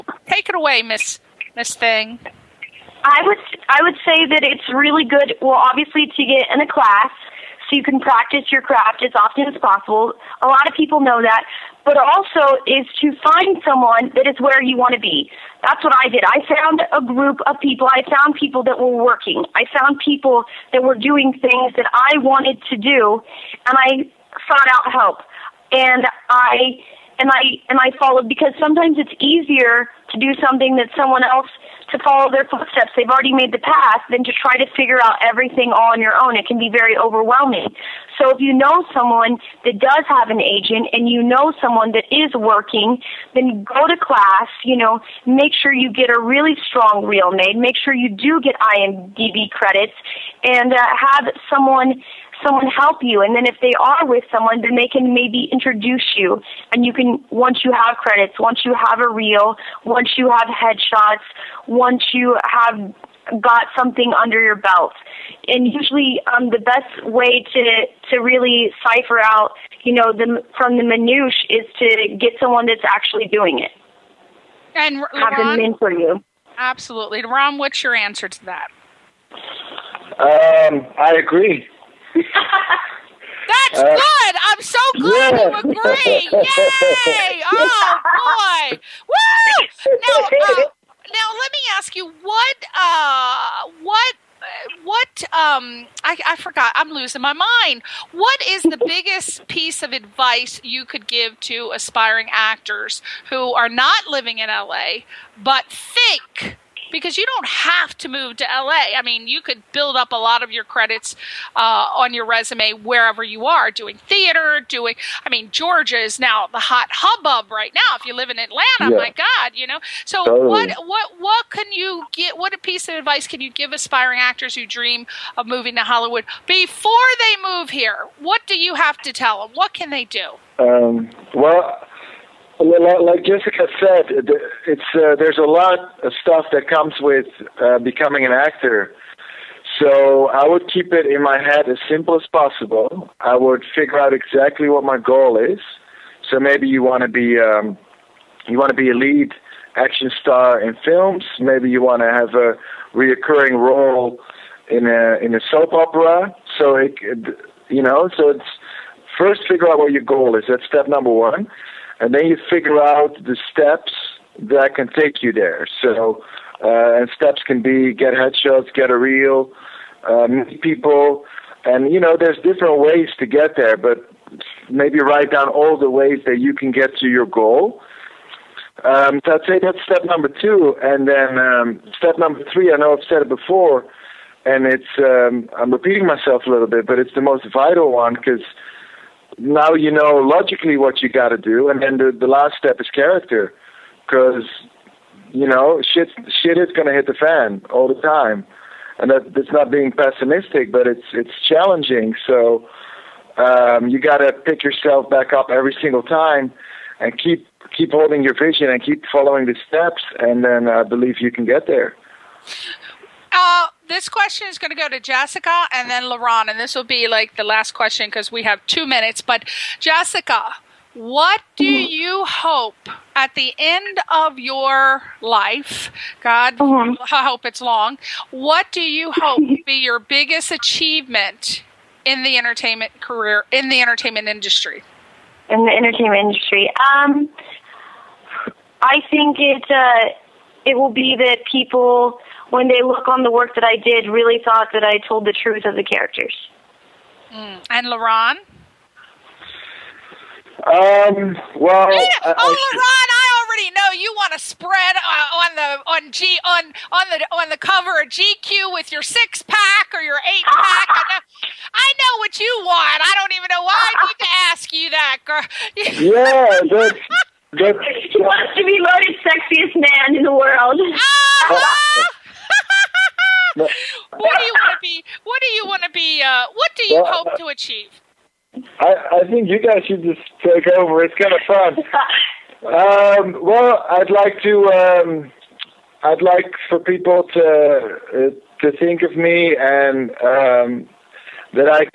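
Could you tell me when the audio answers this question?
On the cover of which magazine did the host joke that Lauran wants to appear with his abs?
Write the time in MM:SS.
04:18.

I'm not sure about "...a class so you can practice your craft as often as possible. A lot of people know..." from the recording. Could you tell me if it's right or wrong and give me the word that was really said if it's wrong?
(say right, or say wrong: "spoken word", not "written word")
right.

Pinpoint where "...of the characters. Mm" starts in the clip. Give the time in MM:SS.
04:05.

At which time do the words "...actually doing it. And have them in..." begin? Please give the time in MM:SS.
01:12.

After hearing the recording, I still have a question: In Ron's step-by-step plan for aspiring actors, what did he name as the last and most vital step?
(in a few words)
Character.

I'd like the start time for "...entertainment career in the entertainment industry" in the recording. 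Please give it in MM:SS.
03:52.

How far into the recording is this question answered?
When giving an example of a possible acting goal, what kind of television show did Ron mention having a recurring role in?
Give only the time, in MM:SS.
02:35.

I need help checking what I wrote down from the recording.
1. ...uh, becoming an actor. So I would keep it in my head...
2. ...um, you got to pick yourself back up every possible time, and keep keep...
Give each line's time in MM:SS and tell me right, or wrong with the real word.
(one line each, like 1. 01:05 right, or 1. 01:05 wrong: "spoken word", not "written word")
1. 02:17 right
2. 03:23 wrong: "single", not "possible".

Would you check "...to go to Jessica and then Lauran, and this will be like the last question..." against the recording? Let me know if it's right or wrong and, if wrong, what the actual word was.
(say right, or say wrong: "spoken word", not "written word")
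right.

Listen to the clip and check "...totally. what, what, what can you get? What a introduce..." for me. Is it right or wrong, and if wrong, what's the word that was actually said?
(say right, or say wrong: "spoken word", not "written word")
wrong: "piece", not "introduce".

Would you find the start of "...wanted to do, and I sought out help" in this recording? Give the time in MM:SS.
00:22.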